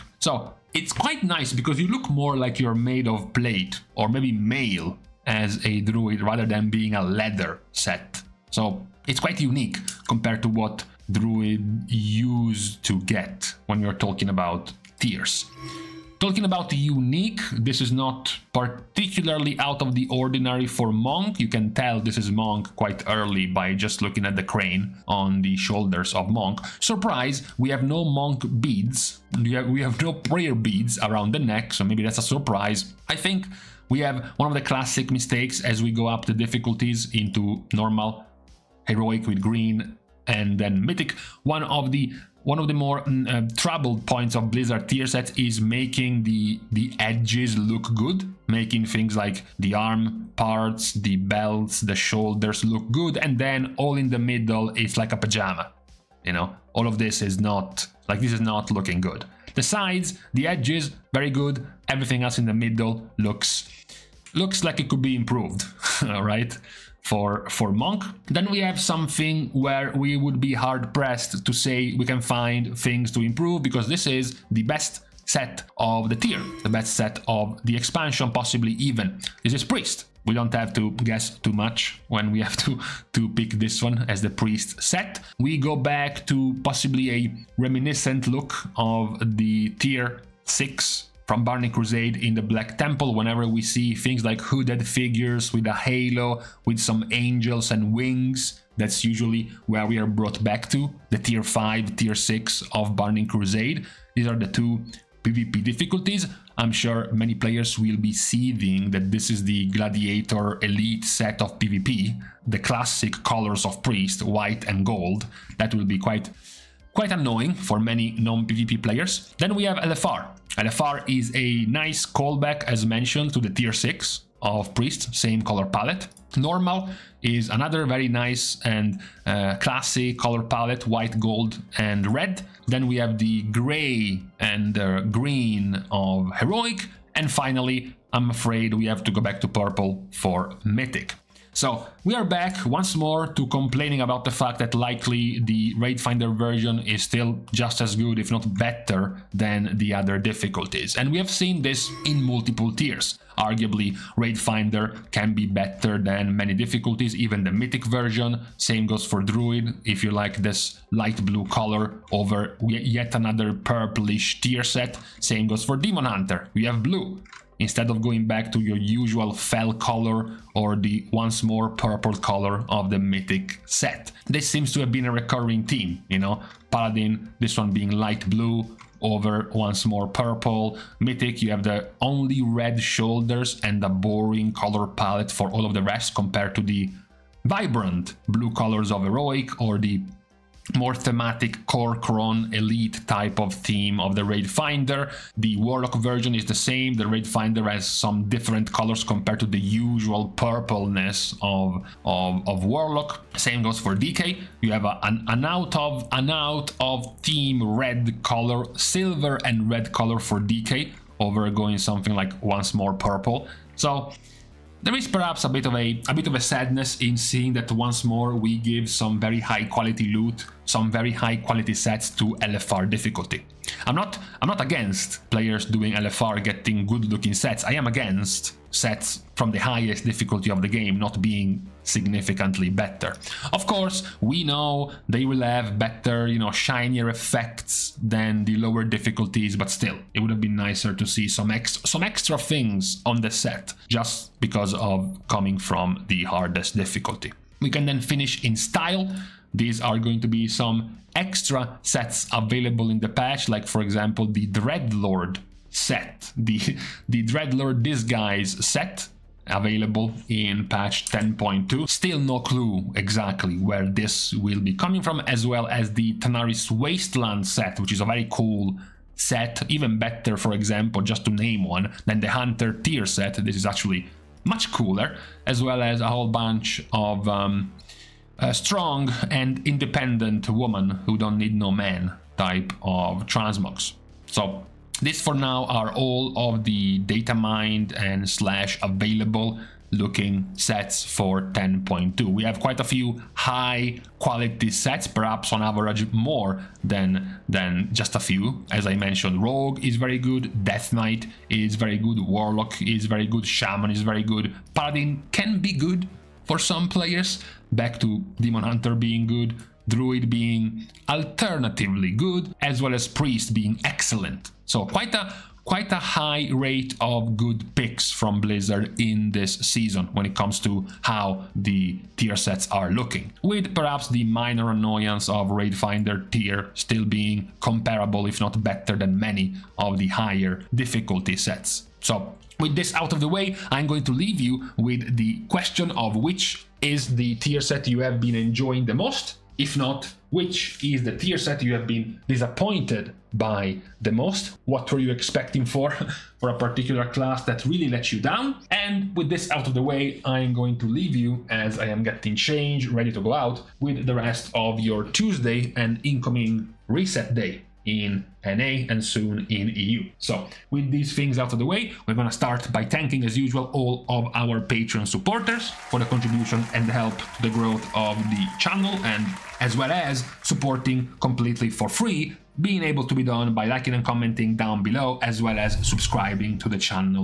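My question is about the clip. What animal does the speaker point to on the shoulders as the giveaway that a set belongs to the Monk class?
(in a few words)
Crane.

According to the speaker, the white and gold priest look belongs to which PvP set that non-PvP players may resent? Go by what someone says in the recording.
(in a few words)
Gladiator Elite.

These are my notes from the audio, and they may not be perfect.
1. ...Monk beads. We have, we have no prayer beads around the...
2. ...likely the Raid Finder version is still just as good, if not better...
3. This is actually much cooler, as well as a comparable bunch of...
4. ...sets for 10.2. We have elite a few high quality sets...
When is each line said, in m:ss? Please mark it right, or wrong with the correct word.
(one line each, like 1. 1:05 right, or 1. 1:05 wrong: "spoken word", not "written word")
1. 0:28 right
2. 2:24 right
3. 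4:33 wrong: "whole", not "comparable"
4. 4:50 wrong: "quite", not "elite".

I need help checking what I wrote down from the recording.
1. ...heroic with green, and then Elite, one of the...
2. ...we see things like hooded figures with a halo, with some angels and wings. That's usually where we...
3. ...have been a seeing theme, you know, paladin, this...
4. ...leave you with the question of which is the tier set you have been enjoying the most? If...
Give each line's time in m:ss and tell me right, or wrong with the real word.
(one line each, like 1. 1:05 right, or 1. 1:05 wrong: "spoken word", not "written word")
1. 0:38 wrong: "Mythic", not "Elite"
2. 1:33 right
3. 2:54 wrong: "recurring", not "seeing"
4. 5:34 right.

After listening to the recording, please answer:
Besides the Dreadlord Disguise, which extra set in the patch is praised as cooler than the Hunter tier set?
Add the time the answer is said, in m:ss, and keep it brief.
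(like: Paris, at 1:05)
Tanaris Wasteland set, at 4:26.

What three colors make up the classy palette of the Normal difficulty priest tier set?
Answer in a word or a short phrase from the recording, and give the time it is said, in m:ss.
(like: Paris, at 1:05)
White, gold, and red, at 2:10.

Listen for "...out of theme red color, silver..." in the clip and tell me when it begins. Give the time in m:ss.
3:26.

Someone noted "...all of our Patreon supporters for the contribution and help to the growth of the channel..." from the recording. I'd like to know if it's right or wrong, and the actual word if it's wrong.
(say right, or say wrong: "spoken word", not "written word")
right.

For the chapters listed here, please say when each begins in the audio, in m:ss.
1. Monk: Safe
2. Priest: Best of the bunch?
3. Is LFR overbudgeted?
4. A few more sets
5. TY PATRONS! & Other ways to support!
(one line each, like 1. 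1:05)
1. 0:15
2. 1:15
3. 2:30
4. 4:07
5. 5:32.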